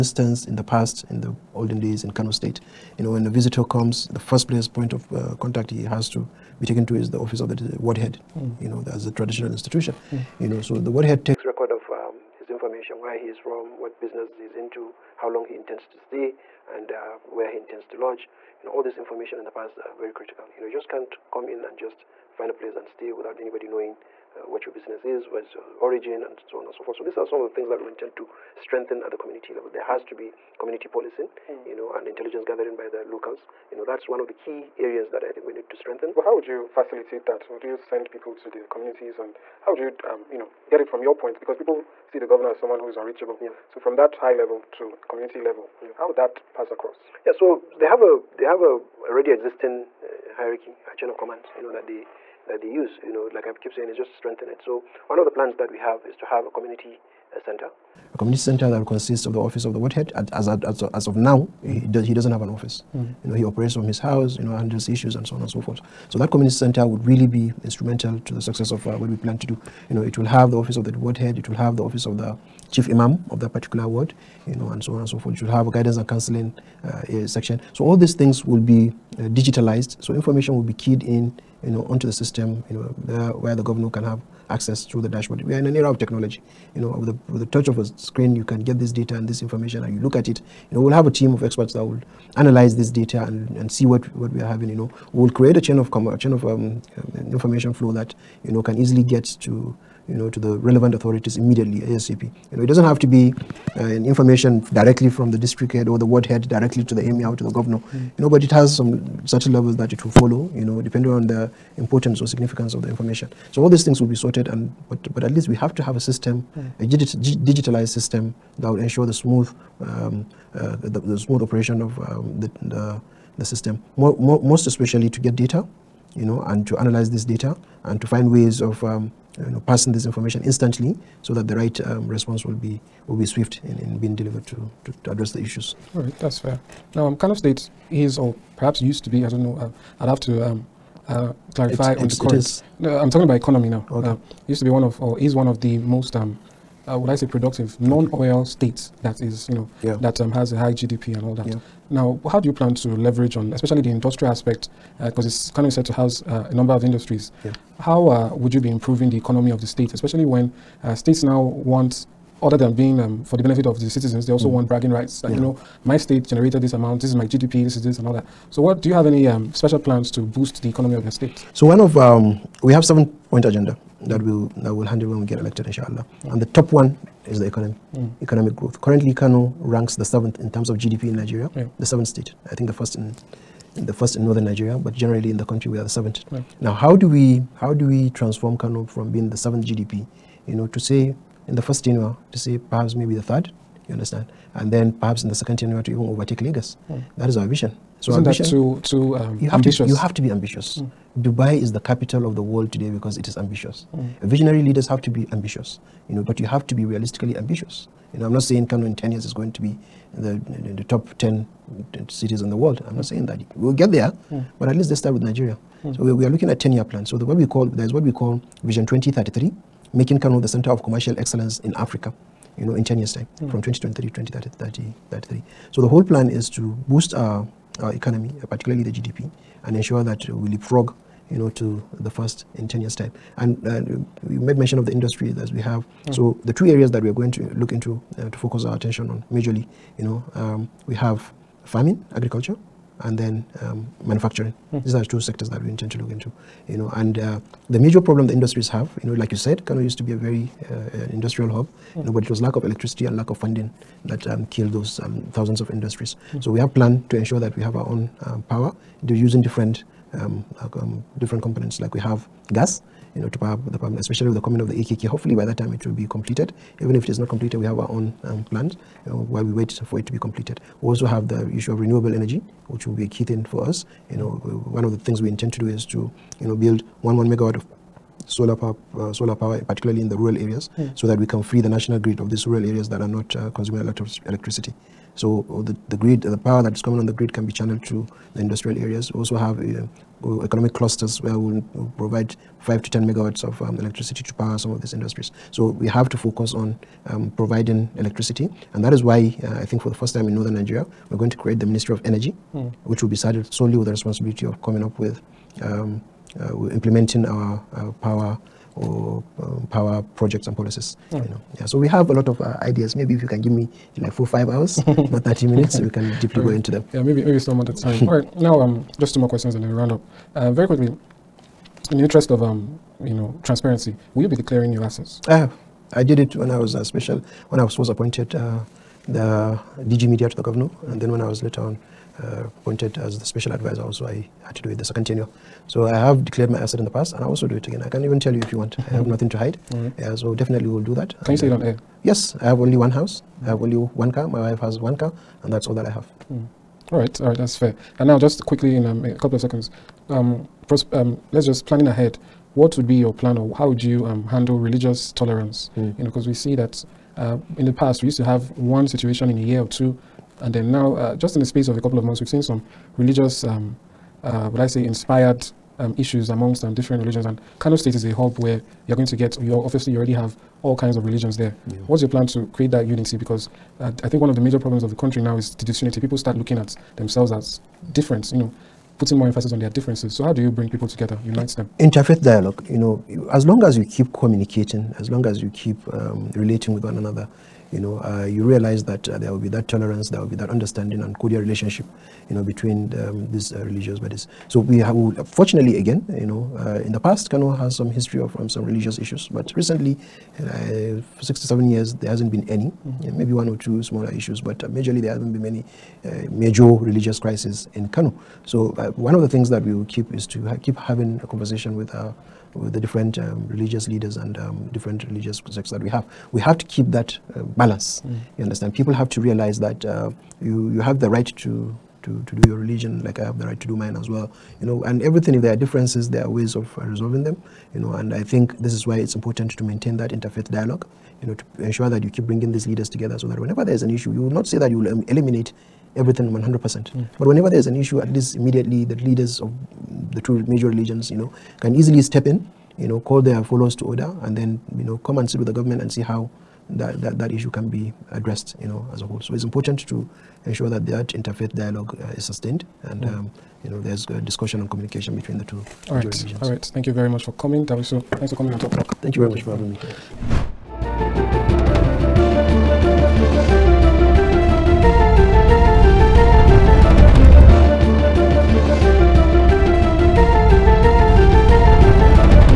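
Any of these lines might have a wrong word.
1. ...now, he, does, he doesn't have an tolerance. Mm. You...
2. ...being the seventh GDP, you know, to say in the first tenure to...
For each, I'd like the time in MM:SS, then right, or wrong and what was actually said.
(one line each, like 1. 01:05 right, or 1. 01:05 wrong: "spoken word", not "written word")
1. 01:01 wrong: "office", not "tolerance"
2. 03:09 right.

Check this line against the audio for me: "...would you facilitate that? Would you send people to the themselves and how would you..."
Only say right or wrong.
wrong.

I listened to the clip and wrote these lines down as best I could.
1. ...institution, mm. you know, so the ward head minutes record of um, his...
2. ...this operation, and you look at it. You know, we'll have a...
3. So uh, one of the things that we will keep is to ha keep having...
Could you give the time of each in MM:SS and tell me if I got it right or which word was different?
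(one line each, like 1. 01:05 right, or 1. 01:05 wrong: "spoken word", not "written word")
1. 00:09 wrong: "takes", not "minutes"
2. 01:29 wrong: "information", not "operation"
3. 06:48 right.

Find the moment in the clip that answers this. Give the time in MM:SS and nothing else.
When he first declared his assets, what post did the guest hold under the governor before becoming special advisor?
05:29.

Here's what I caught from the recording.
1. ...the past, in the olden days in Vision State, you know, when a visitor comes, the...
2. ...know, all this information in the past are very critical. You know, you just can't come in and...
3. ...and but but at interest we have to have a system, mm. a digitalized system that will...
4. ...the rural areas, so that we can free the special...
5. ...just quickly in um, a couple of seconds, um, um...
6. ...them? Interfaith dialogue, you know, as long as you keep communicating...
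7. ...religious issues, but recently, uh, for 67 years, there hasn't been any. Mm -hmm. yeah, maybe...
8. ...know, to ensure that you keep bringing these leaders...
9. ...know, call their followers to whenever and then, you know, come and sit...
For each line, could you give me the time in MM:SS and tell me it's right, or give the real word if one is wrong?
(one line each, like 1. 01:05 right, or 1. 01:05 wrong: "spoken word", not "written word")
1. 00:00 wrong: "Kano", not "Vision"
2. 00:18 right
3. 01:54 wrong: "least", not "interest"
4. 04:40 wrong: "national", not "special"
5. 05:48 right
6. 06:21 right
7. 06:38 right
8. 07:11 right
9. 07:22 wrong: "order", not "whenever".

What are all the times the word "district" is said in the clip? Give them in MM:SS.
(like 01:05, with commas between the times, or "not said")
01:45.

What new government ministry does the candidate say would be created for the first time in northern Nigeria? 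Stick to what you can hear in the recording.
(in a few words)
Ministry of Energy.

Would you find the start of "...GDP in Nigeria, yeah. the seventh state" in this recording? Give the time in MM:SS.
03:00.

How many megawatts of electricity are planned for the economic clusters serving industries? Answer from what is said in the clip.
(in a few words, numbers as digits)
5 to 10 megawatts.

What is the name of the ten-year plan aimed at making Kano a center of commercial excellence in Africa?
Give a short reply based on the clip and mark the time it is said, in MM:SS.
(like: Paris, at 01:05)
Vision 2033, at 03:38.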